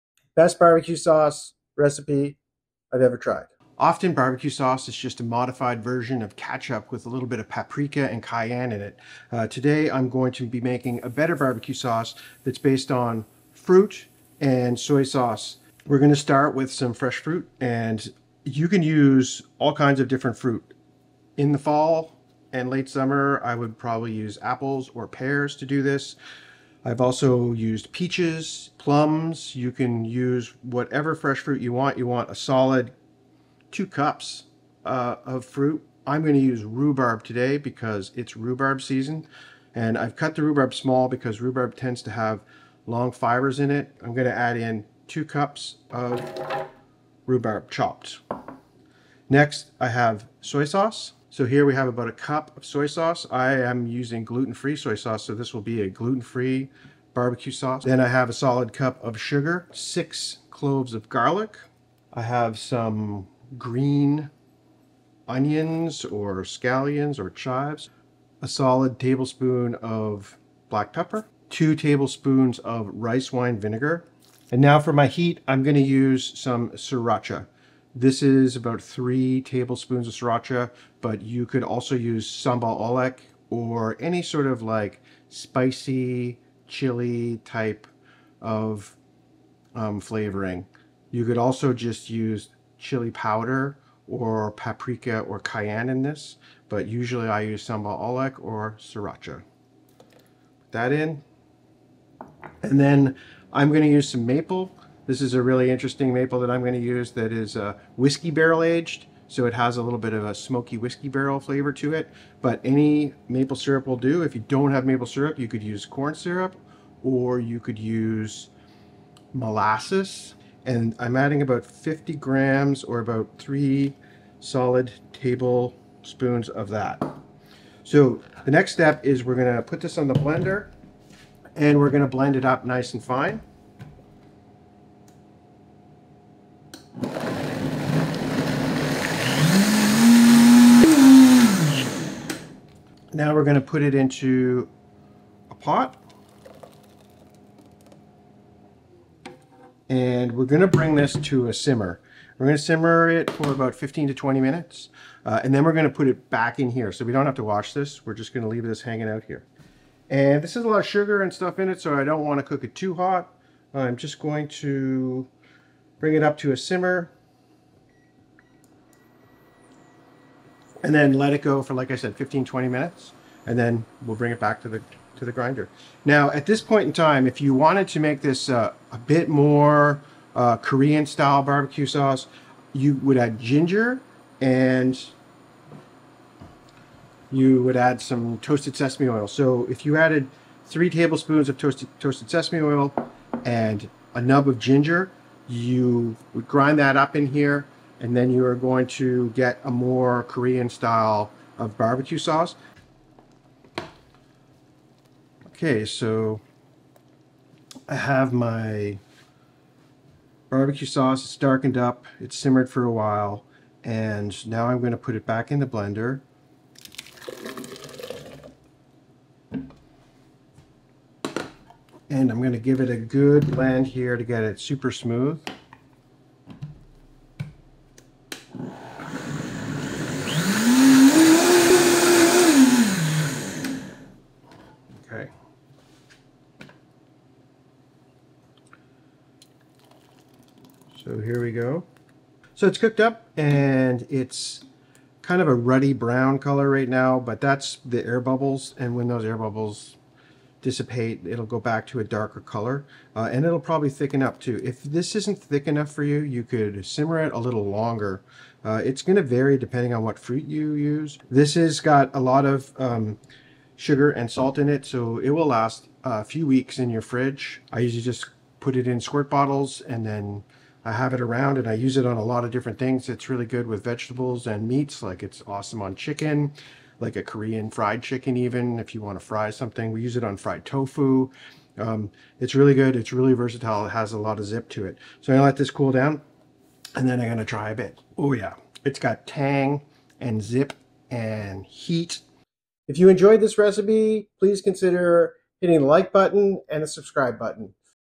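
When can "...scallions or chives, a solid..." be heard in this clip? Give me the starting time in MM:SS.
01:06.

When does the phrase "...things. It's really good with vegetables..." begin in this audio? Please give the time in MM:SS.
04:32.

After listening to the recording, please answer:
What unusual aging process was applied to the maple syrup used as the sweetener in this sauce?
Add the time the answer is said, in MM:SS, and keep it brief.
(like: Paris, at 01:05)
whiskey barrel aged, at 01:47.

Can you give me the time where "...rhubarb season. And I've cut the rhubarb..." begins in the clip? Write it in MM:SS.
00:38.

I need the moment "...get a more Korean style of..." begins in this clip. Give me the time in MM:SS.
03:19.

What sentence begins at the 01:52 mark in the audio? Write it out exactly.
But any maple syrup will do.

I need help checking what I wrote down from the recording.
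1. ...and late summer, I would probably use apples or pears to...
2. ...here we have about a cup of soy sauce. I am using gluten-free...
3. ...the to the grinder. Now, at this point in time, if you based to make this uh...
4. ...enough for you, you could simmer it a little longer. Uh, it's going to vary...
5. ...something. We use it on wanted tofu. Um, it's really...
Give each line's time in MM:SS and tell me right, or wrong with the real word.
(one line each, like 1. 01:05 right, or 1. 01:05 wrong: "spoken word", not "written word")
1. 00:22 right
2. 00:51 right
3. 02:54 wrong: "wanted", not "based"
4. 04:15 right
5. 04:39 wrong: "fried", not "wanted".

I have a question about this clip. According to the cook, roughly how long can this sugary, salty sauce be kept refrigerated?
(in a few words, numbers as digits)
a few weeks.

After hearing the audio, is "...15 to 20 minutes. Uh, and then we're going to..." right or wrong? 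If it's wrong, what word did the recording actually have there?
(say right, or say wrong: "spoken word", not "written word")
right.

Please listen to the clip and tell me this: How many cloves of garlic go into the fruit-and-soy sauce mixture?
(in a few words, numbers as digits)
6.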